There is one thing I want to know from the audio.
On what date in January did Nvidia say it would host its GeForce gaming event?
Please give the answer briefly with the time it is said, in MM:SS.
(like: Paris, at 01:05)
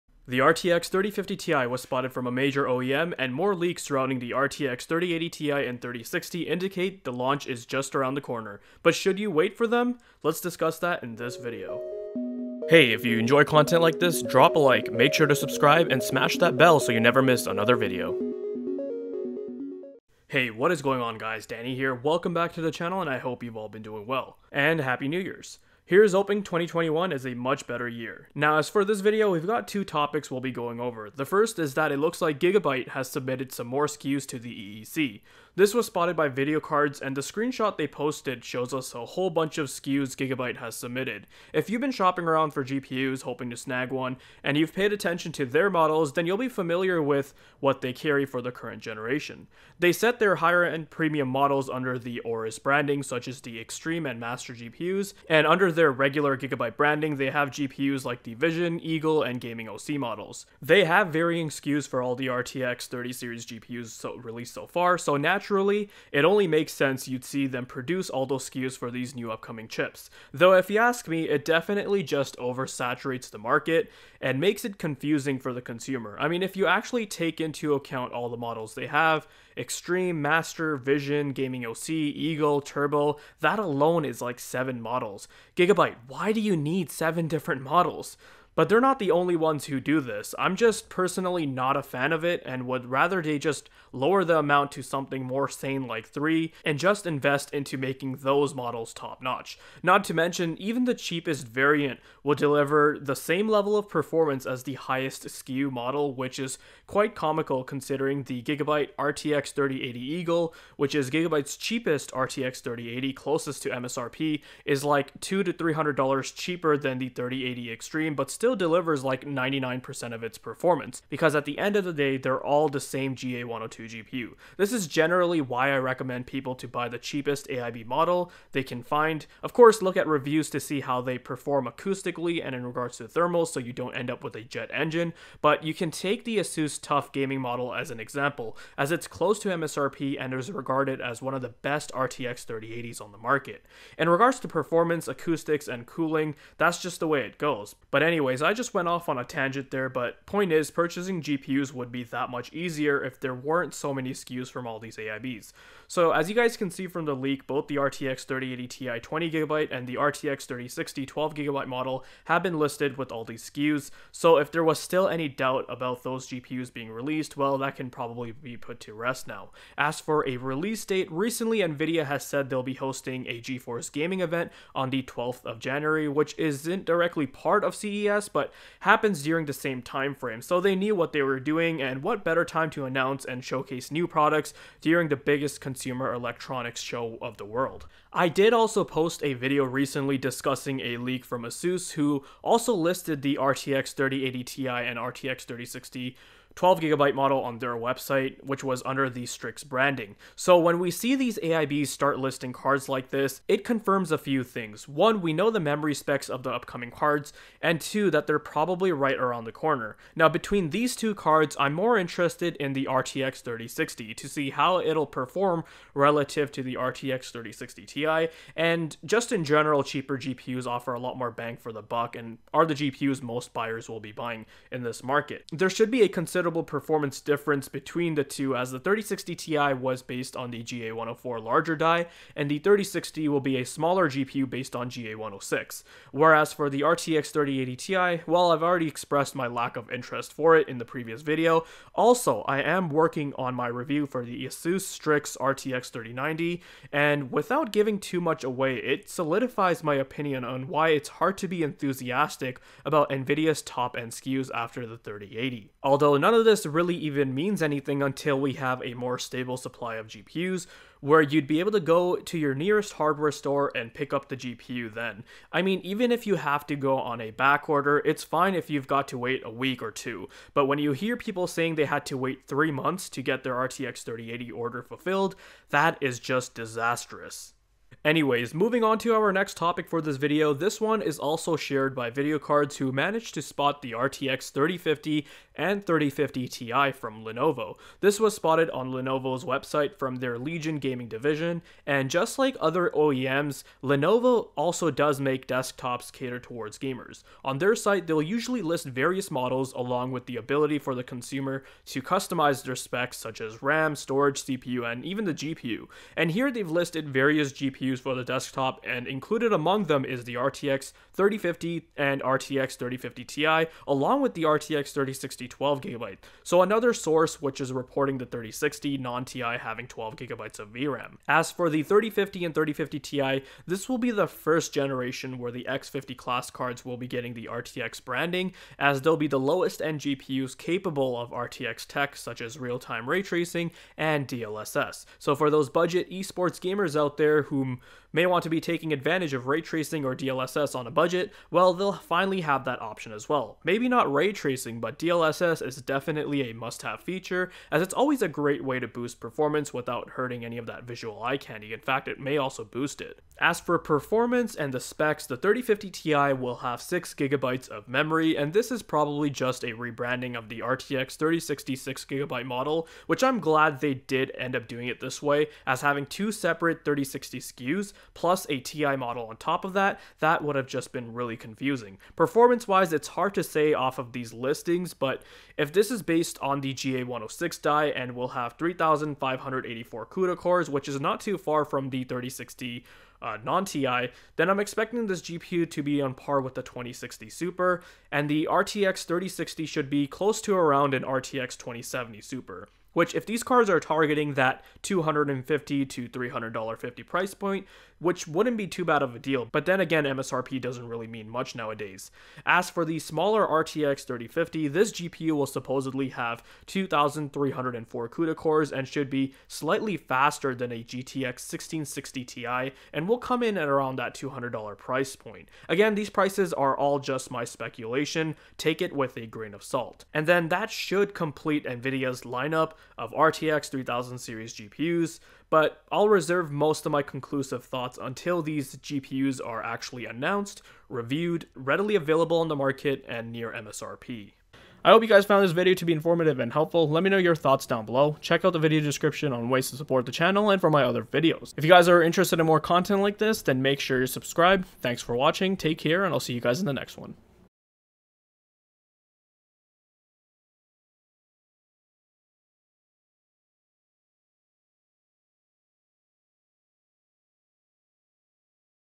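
12th of January, at 02:55.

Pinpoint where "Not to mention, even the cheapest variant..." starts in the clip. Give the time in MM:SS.
01:39.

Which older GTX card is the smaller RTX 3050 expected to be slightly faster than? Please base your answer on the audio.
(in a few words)
GTX 1660 Ti.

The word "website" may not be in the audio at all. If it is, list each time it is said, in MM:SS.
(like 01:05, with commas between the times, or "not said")
03:17, 04:49.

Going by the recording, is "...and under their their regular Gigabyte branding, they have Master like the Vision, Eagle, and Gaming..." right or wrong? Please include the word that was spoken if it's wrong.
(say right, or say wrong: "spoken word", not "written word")
wrong: "GPUs", not "Master".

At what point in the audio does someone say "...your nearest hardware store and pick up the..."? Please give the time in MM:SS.
04:22.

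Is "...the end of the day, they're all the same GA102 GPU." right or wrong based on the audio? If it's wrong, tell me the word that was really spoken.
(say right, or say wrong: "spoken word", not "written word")
right.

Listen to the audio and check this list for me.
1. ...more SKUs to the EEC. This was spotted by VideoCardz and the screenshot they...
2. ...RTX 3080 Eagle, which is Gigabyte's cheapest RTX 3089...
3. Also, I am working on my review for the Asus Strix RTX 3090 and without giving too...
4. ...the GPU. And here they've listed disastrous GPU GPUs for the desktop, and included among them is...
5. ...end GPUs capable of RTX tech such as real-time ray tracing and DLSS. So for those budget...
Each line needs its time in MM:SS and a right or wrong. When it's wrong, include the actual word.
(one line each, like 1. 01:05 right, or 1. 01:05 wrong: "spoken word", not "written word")
1. 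00:33 right
2. 01:48 wrong: "3080", not "3089"
3. 04:01 right
4. 05:05 wrong: "various", not "disastrous"
5. 05:29 right.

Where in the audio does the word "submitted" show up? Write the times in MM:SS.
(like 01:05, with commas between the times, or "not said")
00:33, 00:40.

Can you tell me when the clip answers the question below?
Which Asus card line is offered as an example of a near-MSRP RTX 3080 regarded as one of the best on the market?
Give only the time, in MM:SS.
02:16.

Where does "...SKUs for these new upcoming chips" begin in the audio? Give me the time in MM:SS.
01:08.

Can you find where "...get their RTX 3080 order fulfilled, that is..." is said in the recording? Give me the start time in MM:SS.
04:33.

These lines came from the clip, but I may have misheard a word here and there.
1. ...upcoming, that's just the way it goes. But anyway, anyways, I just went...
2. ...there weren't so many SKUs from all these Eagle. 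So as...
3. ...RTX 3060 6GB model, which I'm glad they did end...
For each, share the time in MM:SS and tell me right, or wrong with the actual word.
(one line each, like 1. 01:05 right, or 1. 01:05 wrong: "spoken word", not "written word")
1. 02:25 wrong: "cooling", not "upcoming"
2. 02:33 wrong: "AIBs", not "Eagle"
3. 06:00 right.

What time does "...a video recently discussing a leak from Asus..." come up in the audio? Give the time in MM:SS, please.
03:09.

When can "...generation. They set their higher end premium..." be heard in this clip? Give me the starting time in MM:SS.
00:48.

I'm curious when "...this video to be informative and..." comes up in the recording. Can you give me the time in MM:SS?
07:15.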